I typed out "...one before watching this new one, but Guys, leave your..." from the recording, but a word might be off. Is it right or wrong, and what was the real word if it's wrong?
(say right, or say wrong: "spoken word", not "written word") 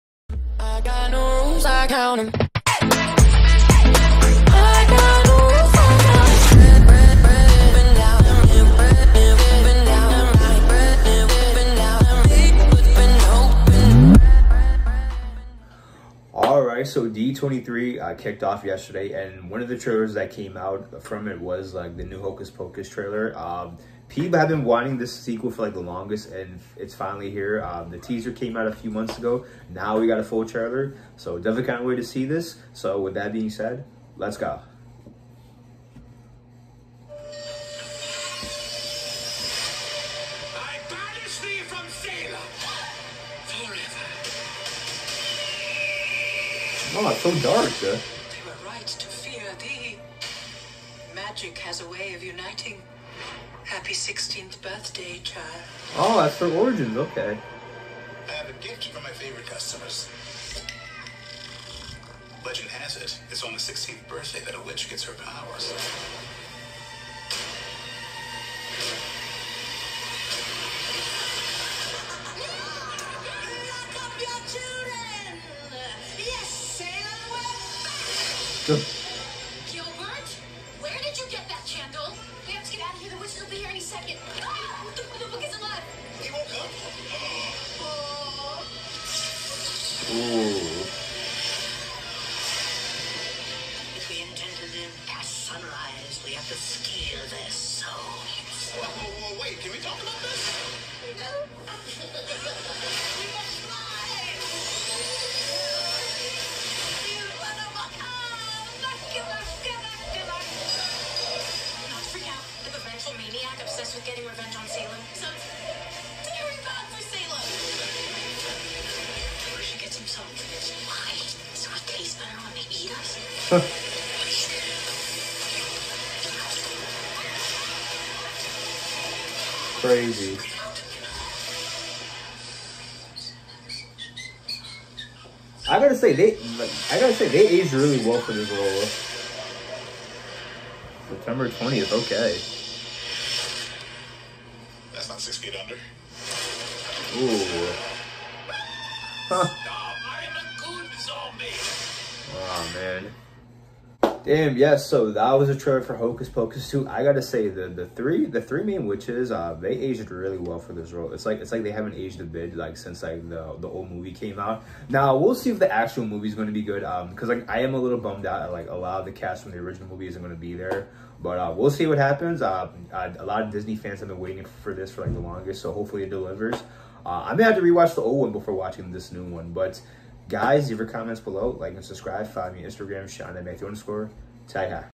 right.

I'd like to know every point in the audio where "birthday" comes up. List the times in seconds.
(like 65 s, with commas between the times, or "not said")
54 s, 64 s.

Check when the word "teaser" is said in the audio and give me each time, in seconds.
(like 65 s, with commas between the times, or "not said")
27 s.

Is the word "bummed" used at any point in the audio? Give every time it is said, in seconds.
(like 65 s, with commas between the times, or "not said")
167 s.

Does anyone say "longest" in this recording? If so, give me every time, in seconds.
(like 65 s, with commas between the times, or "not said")
25 s, 175 s.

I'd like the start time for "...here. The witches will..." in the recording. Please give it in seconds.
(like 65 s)
83 s.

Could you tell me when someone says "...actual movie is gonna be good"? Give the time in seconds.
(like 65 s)
165 s.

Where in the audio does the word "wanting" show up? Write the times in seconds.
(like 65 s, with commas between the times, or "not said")
24 s.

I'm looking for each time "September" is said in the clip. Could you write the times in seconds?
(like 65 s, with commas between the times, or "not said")
141 s.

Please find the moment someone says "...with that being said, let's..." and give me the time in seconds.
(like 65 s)
32 s.